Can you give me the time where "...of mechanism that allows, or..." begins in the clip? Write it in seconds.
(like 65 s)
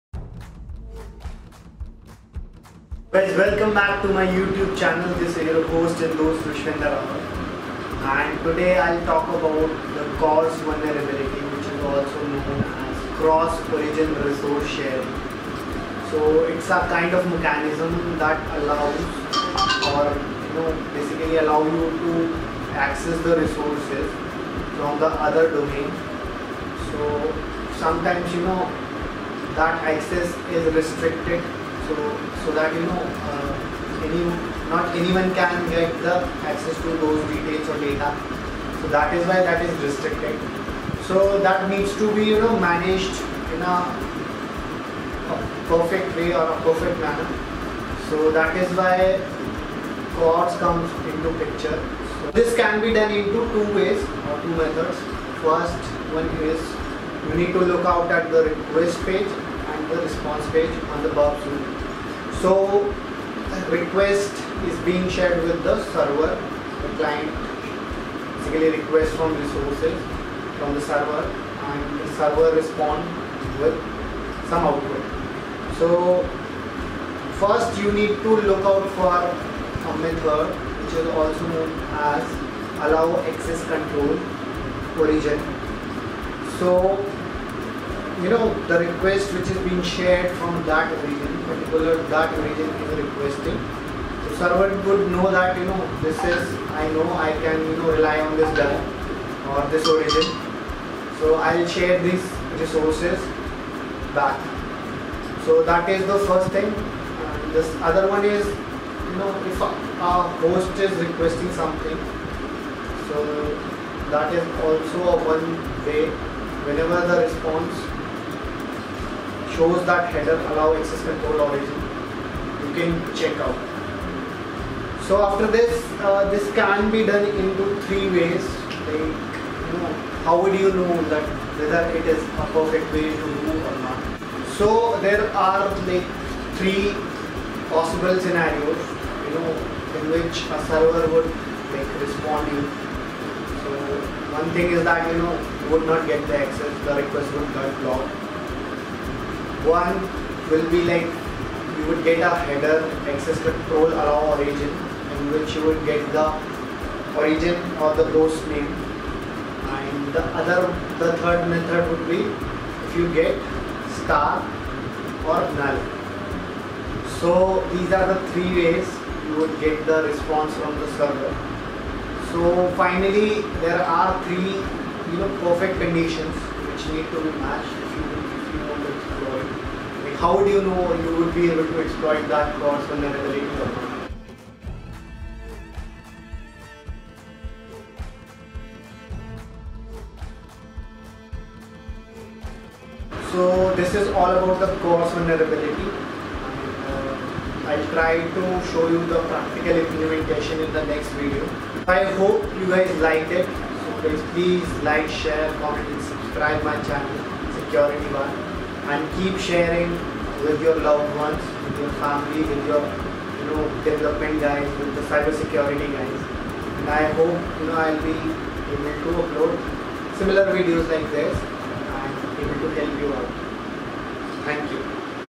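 17 s.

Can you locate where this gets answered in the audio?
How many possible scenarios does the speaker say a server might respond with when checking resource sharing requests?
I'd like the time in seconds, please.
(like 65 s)
136 s.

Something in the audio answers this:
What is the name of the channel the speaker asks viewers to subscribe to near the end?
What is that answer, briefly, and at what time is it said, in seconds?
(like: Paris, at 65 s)
security one, at 207 s.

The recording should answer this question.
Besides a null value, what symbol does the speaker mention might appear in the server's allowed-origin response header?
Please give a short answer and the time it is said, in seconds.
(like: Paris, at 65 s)
star, at 163 s.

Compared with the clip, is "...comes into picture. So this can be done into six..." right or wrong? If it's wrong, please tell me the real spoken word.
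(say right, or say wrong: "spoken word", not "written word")
wrong: "two", not "six".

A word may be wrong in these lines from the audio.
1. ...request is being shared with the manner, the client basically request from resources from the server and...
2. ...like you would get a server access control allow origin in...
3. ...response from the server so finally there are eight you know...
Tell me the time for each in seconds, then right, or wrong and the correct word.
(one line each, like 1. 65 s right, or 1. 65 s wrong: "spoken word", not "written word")
1. 63 s wrong: "server", not "manner"
2. 150 s wrong: "header", not "server"
3. 170 s wrong: "three", not "eight".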